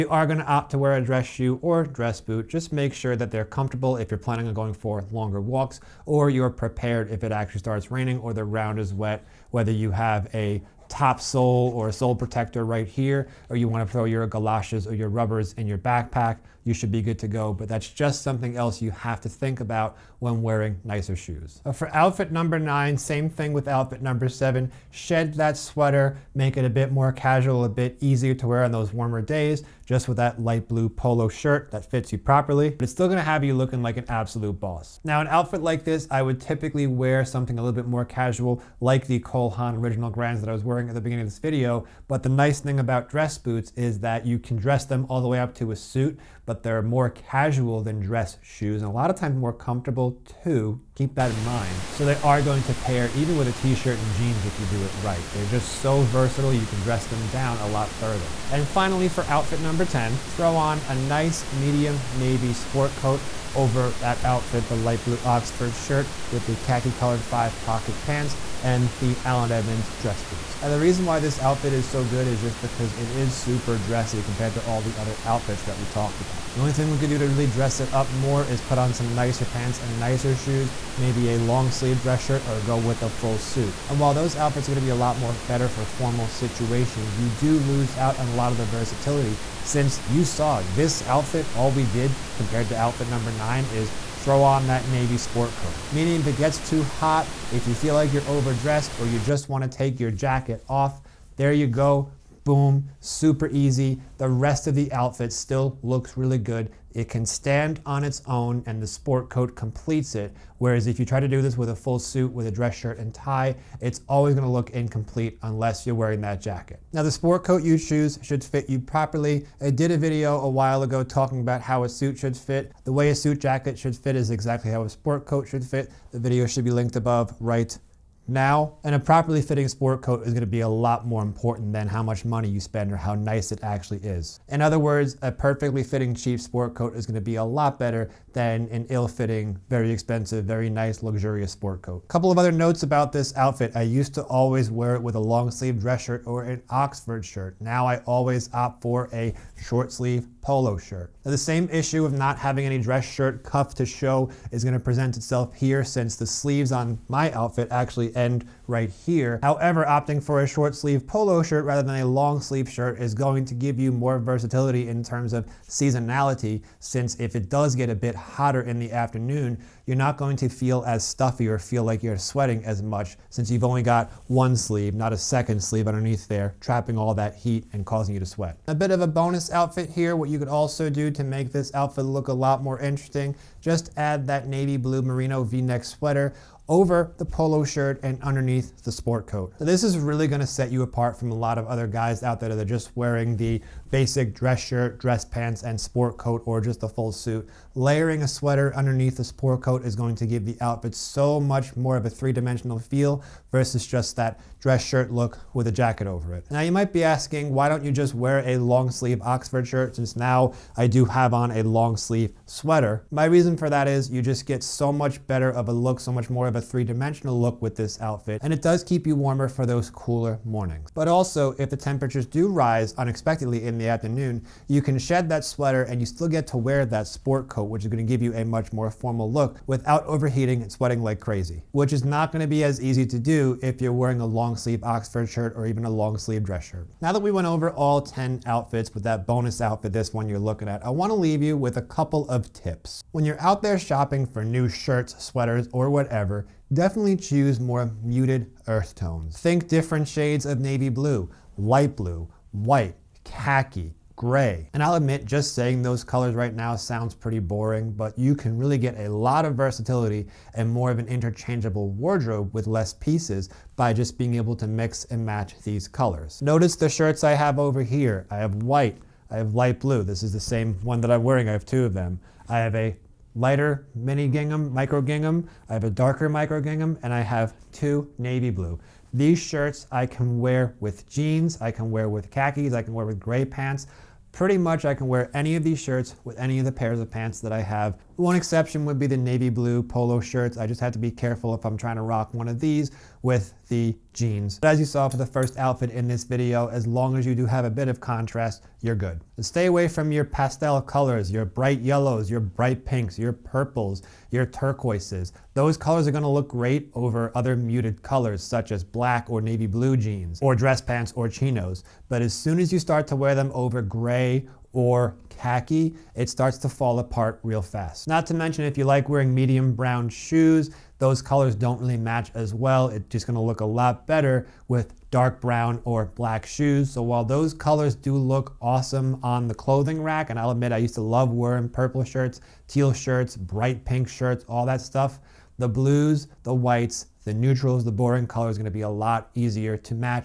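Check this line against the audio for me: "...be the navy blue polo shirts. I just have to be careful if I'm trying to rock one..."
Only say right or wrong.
right.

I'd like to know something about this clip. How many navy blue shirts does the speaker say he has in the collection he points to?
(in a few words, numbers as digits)
2.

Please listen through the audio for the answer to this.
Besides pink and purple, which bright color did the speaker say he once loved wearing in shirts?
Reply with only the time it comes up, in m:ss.
5:32.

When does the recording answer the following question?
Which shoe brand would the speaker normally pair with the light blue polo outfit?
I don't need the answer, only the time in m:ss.
0:39.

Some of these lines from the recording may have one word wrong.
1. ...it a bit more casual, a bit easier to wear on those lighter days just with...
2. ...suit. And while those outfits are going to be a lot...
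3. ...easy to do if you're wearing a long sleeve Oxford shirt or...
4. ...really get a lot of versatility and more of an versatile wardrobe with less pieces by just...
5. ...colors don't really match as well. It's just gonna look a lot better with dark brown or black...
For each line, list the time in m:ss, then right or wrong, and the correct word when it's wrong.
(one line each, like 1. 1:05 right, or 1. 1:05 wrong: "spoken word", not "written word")
1. 0:26 wrong: "warmer", not "lighter"
2. 1:23 right
3. 3:52 right
4. 4:18 wrong: "interchangeable", not "versatile"
5. 5:21 right.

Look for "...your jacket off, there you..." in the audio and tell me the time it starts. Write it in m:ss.
1:39.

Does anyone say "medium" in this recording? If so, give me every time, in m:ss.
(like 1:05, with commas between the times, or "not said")
1:01, 5:19.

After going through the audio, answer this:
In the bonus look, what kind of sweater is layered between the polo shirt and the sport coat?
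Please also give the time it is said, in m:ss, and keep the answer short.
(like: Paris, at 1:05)
merino v-neck, at 3:05.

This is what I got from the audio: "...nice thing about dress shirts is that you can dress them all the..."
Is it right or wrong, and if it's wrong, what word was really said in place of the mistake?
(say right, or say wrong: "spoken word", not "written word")
wrong: "boots", not "shirts".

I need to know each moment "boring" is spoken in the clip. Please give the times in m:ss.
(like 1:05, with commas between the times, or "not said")
4:17, 5:37.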